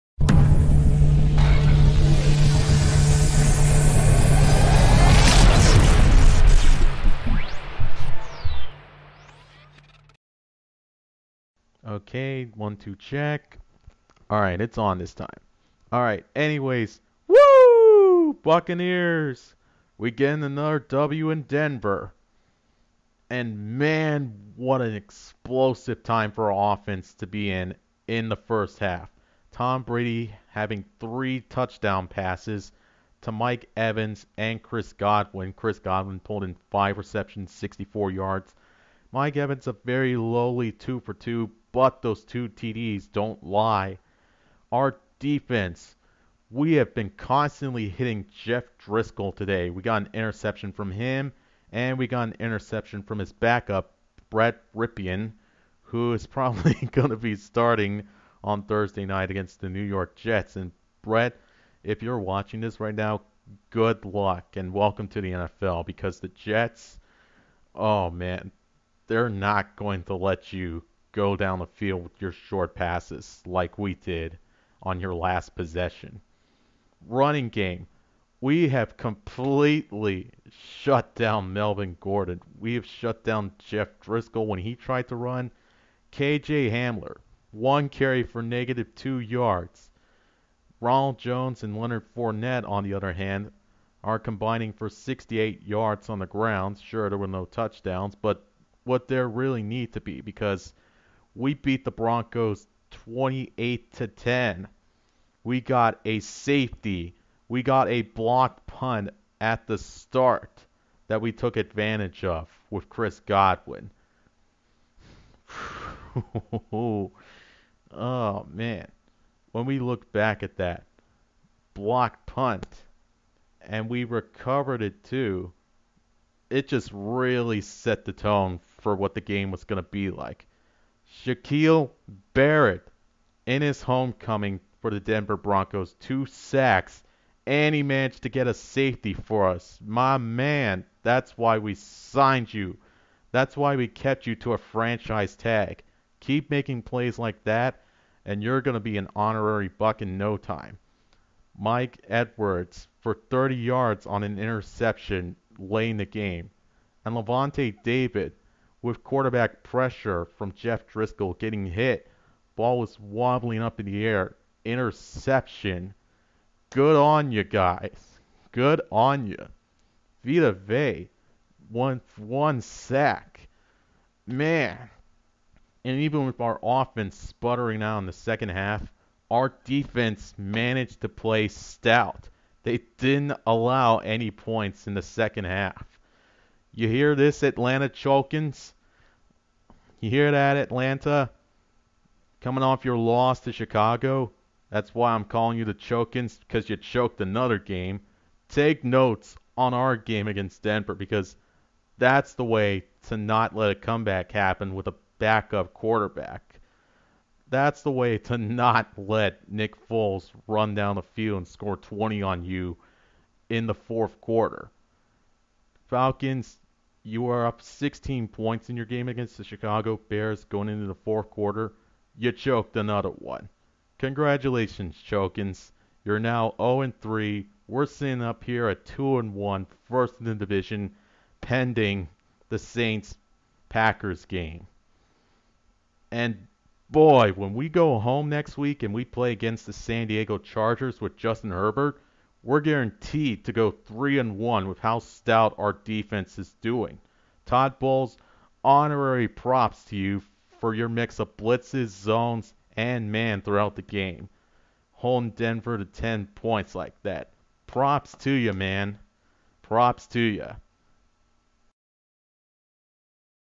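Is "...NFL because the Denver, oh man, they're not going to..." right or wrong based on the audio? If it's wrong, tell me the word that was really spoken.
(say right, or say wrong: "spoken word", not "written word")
wrong: "Jets", not "Denver".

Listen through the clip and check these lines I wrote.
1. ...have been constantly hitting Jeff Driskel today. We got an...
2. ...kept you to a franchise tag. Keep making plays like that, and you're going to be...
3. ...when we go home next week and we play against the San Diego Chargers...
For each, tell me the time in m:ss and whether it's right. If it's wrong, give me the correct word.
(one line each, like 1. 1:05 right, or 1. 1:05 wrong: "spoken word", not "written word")
1. 0:46 right
2. 2:23 right
3. 3:57 right.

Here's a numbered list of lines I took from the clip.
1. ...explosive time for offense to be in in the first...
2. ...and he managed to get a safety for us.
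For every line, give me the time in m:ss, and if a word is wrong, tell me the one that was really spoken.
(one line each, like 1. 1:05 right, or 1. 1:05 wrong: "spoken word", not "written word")
1. 0:24 right
2. 2:17 right.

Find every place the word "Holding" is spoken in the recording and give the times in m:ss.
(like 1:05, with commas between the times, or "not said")
4:14.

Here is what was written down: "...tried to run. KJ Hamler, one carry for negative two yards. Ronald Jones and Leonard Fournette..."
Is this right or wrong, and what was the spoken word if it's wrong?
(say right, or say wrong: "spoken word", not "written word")
right.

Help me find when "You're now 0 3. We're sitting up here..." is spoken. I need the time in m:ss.
3:46.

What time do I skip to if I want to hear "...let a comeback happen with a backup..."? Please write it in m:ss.
3:23.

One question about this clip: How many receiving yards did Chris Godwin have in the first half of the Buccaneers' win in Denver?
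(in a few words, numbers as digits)
64.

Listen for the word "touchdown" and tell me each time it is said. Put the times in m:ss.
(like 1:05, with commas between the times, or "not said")
0:31, 1:37.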